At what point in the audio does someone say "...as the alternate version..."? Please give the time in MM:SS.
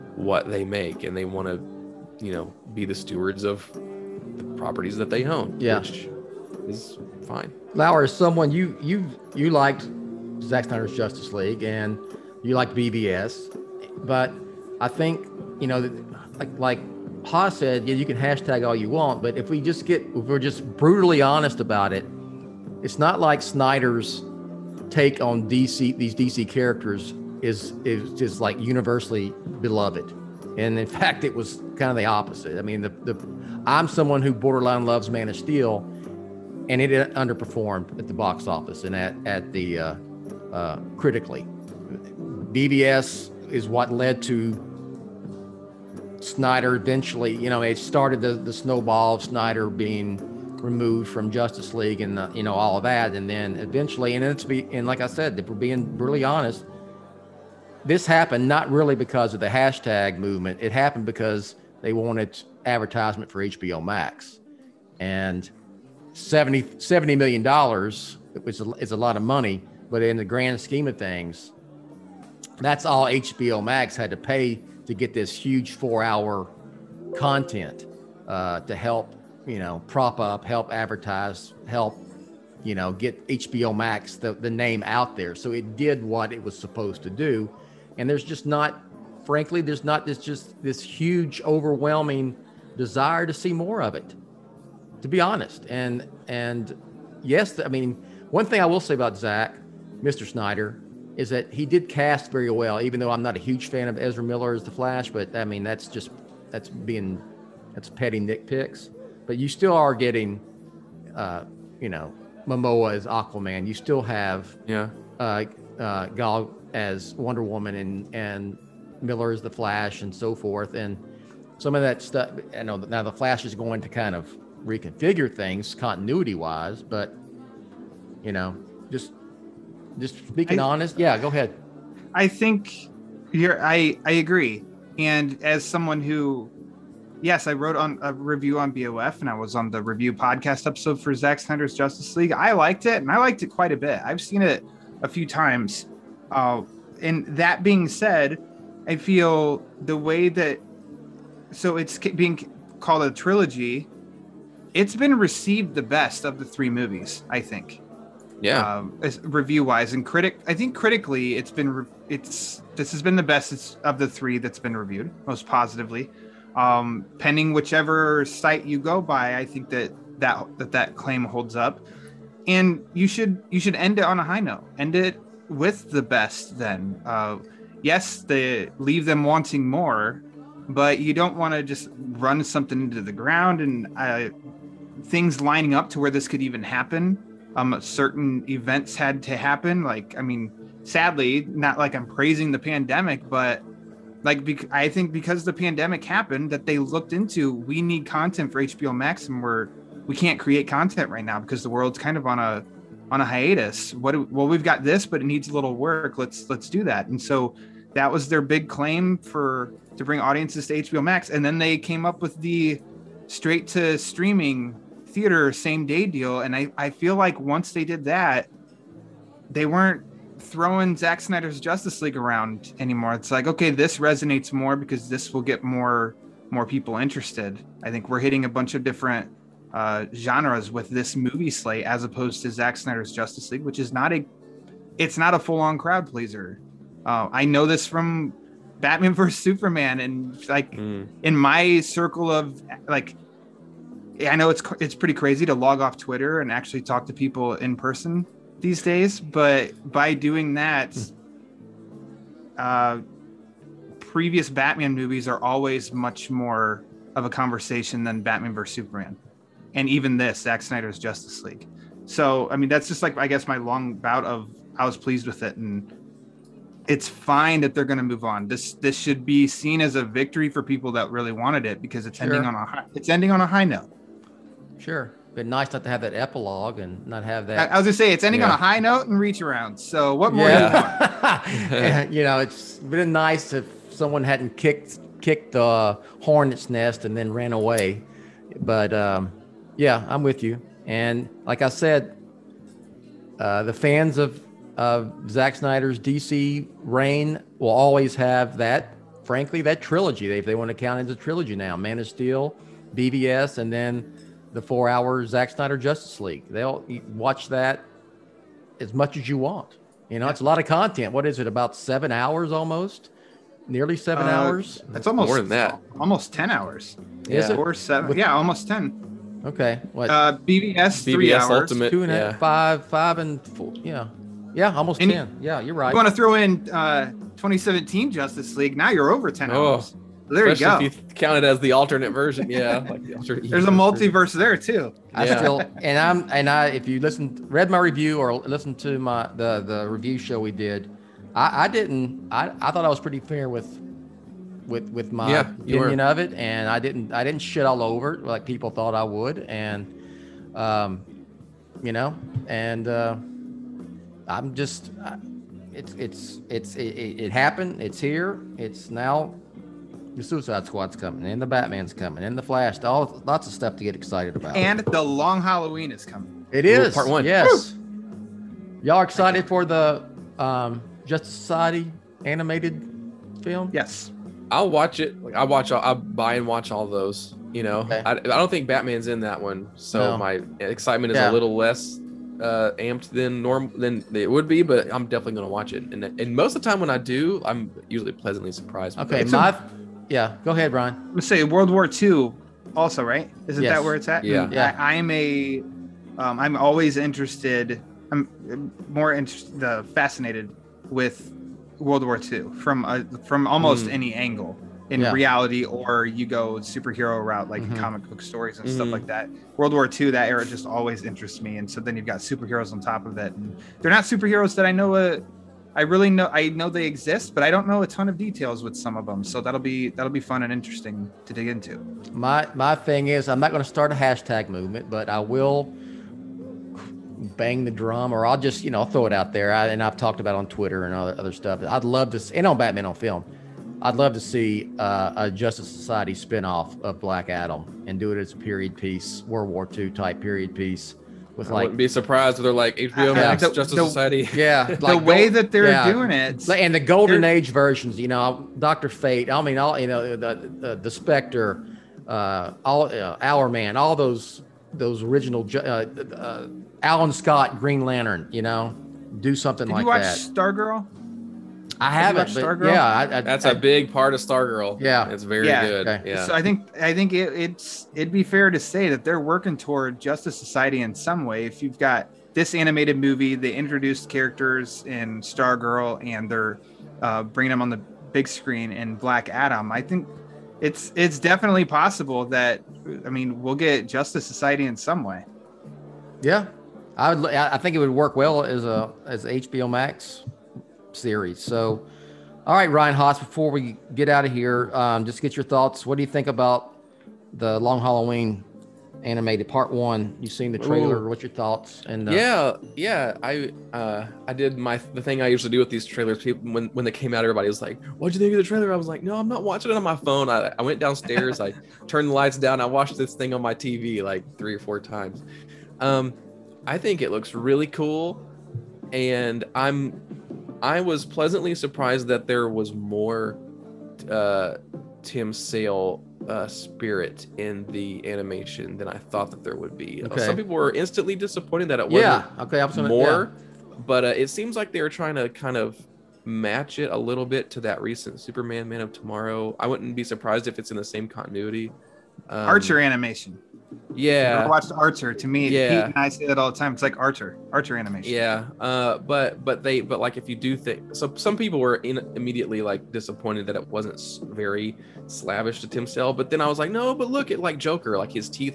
05:31.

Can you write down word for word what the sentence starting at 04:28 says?
This this should be seen as a victory for people that really wanted it because it's sure.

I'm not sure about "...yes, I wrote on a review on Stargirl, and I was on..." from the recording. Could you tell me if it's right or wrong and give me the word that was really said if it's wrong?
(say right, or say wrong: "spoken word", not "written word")
wrong: "BOF", not "Stargirl".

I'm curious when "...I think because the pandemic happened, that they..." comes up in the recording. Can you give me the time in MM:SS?
03:14.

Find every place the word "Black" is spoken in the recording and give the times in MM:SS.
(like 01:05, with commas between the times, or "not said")
07:16, 07:58.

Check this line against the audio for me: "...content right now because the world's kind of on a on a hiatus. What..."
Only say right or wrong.
right.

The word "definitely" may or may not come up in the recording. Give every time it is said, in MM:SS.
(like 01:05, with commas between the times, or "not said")
06:25, 08:01.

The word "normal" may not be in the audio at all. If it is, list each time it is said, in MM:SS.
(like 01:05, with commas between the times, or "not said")
06:23.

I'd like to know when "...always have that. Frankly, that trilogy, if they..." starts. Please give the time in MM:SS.
04:57.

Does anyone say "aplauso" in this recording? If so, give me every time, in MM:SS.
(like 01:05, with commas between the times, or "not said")
not said.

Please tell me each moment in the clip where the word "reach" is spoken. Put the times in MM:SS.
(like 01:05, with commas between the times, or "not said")
04:39.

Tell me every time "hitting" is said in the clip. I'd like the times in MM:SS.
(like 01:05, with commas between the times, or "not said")
03:48.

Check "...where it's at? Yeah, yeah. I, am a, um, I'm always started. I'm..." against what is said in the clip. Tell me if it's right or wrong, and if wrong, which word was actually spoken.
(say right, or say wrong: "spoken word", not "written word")
wrong: "interested", not "started".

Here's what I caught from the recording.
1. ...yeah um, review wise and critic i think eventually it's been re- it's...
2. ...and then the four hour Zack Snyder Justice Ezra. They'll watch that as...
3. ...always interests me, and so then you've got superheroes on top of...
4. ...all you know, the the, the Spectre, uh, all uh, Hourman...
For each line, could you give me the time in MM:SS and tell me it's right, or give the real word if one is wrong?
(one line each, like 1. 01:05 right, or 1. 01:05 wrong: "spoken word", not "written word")
1. 02:38 wrong: "critically", not "eventually"
2. 05:03 wrong: "League", not "Ezra"
3. 06:50 right
4. 07:29 right.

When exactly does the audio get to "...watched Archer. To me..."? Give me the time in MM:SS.
09:04.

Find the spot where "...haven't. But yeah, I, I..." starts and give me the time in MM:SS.
07:41.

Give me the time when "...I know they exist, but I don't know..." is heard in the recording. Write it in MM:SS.
06:56.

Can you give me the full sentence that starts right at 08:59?
I wouldn't be surprised if it's in the same continuity.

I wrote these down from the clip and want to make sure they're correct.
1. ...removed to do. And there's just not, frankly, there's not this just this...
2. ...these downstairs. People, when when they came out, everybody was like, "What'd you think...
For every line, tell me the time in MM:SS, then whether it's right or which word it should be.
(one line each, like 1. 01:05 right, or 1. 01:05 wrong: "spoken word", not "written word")
1. 01:26 wrong: "supposed", not "removed"
2. 08:25 wrong: "trailers", not "downstairs".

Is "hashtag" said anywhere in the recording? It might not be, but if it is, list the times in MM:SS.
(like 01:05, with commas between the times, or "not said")
00:18, 00:59, 07:03.